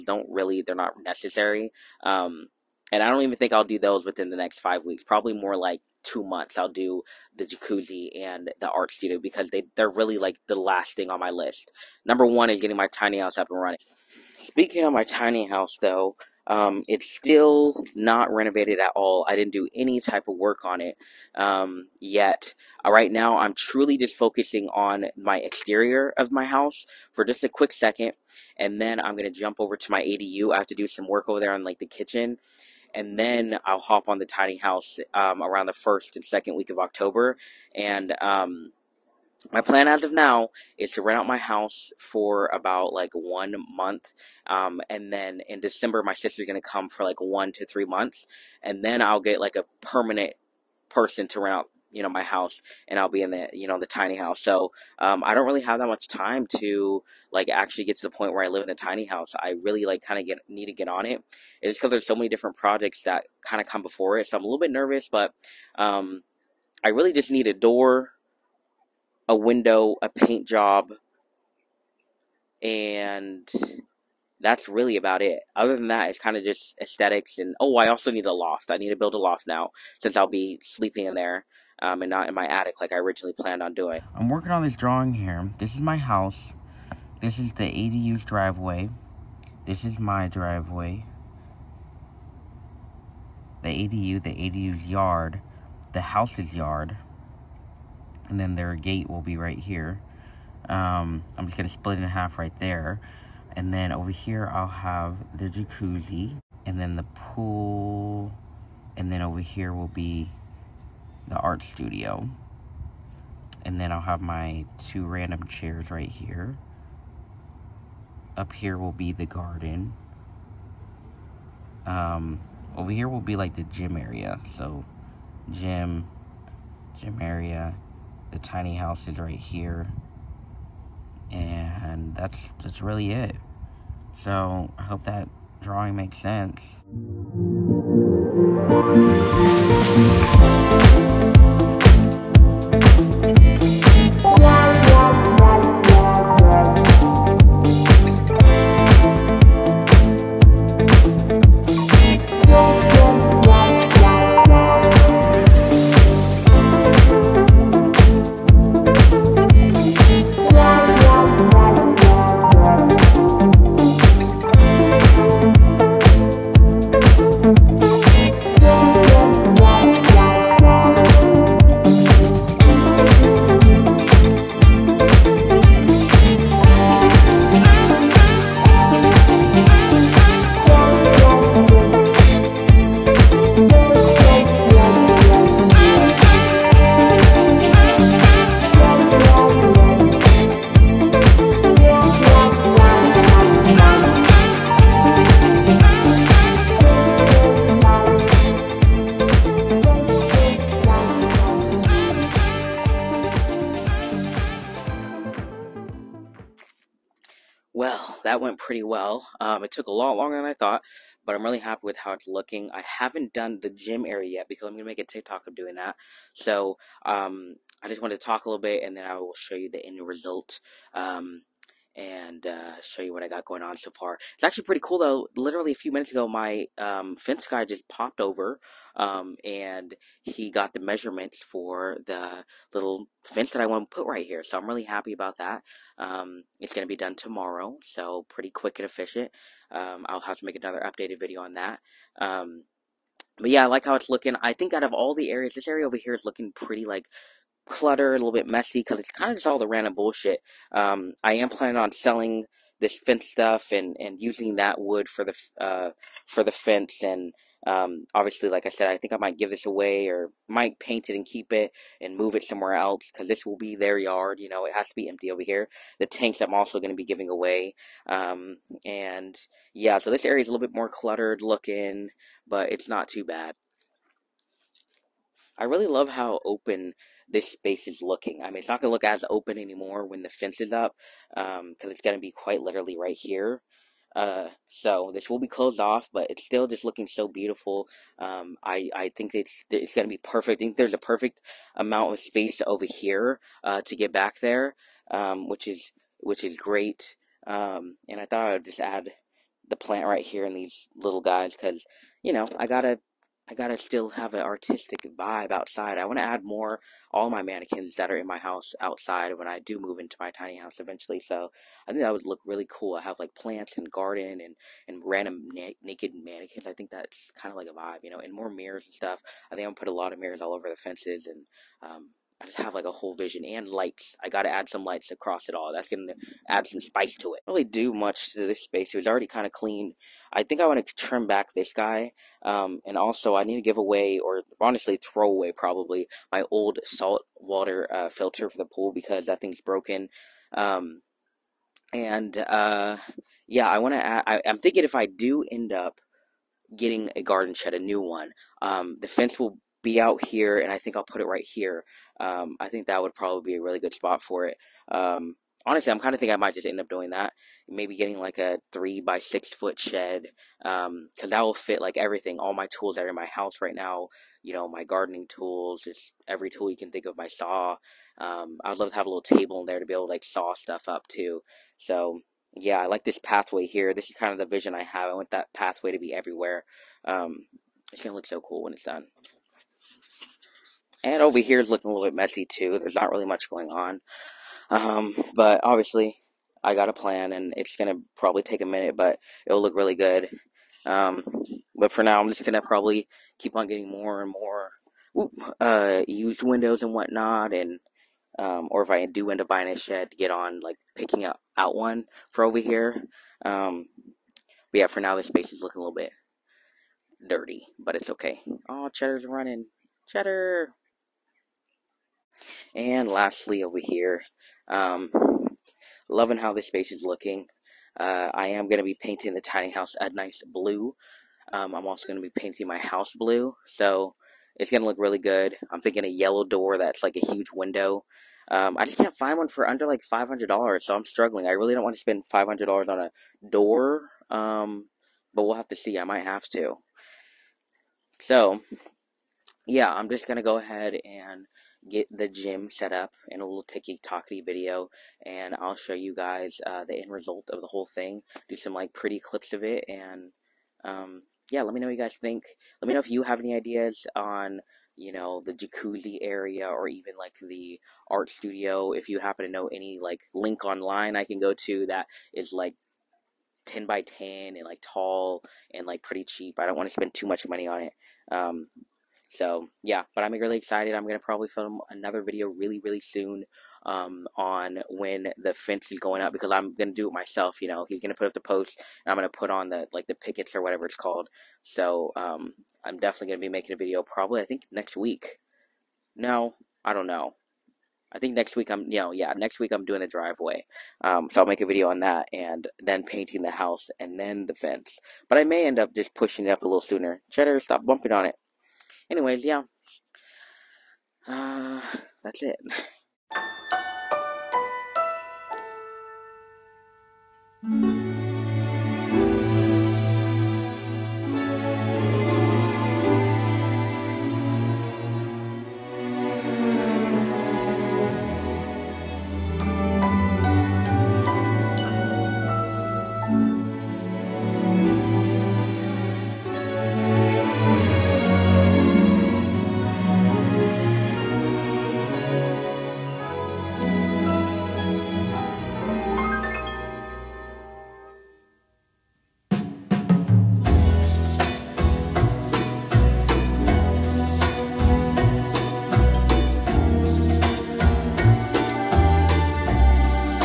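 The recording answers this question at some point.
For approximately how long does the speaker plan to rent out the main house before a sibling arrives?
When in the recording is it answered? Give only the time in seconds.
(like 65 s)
43 s.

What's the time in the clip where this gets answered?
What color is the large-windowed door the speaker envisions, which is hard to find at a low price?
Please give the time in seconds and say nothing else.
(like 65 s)
426 s.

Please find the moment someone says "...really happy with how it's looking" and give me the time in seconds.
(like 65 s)
211 s.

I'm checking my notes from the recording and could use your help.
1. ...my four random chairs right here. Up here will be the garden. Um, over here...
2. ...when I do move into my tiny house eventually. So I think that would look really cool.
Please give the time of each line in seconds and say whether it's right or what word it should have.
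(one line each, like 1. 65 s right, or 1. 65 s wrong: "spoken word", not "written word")
1. 114 s wrong: "two", not "four"
2. 309 s right.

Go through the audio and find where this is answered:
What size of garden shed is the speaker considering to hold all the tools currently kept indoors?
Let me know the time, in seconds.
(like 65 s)
358 s.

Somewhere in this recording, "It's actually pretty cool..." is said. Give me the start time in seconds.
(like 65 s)
224 s.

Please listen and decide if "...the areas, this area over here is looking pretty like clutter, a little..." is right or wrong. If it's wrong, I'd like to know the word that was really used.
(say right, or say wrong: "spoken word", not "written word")
right.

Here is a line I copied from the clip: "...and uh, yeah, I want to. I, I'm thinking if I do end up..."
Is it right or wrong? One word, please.
right.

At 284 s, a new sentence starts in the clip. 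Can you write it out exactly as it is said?
Uh, so this will be closed off, but it's still just looking so beautiful.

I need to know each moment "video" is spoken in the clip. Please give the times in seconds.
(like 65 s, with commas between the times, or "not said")
241 s, 444 s, 472 s, 483 s, 491 s.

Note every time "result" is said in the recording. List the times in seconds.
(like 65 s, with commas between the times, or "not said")
220 s, 447 s.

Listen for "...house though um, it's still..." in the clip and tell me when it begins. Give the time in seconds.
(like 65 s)
15 s.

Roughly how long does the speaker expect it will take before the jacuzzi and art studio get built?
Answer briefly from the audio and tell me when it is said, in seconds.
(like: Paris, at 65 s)
2 months, at 6 s.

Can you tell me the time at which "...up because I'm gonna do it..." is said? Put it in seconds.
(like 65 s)
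476 s.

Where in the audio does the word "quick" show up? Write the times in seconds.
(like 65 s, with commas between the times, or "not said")
27 s, 238 s.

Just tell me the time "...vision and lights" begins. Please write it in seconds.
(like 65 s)
323 s.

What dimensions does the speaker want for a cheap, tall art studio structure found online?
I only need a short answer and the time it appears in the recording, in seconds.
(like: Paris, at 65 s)
10 by 10, at 463 s.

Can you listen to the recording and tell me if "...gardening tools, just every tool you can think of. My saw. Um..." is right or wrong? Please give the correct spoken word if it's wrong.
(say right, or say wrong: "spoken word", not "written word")
right.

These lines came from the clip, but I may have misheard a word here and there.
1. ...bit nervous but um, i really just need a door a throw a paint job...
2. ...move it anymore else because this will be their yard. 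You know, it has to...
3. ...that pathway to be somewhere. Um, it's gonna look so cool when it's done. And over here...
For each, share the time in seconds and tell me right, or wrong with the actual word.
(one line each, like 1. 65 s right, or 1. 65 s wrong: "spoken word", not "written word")
1. 64 s wrong: "window", not "throw"
2. 262 s wrong: "somewhere", not "anymore"
3. 375 s wrong: "everywhere", not "somewhere".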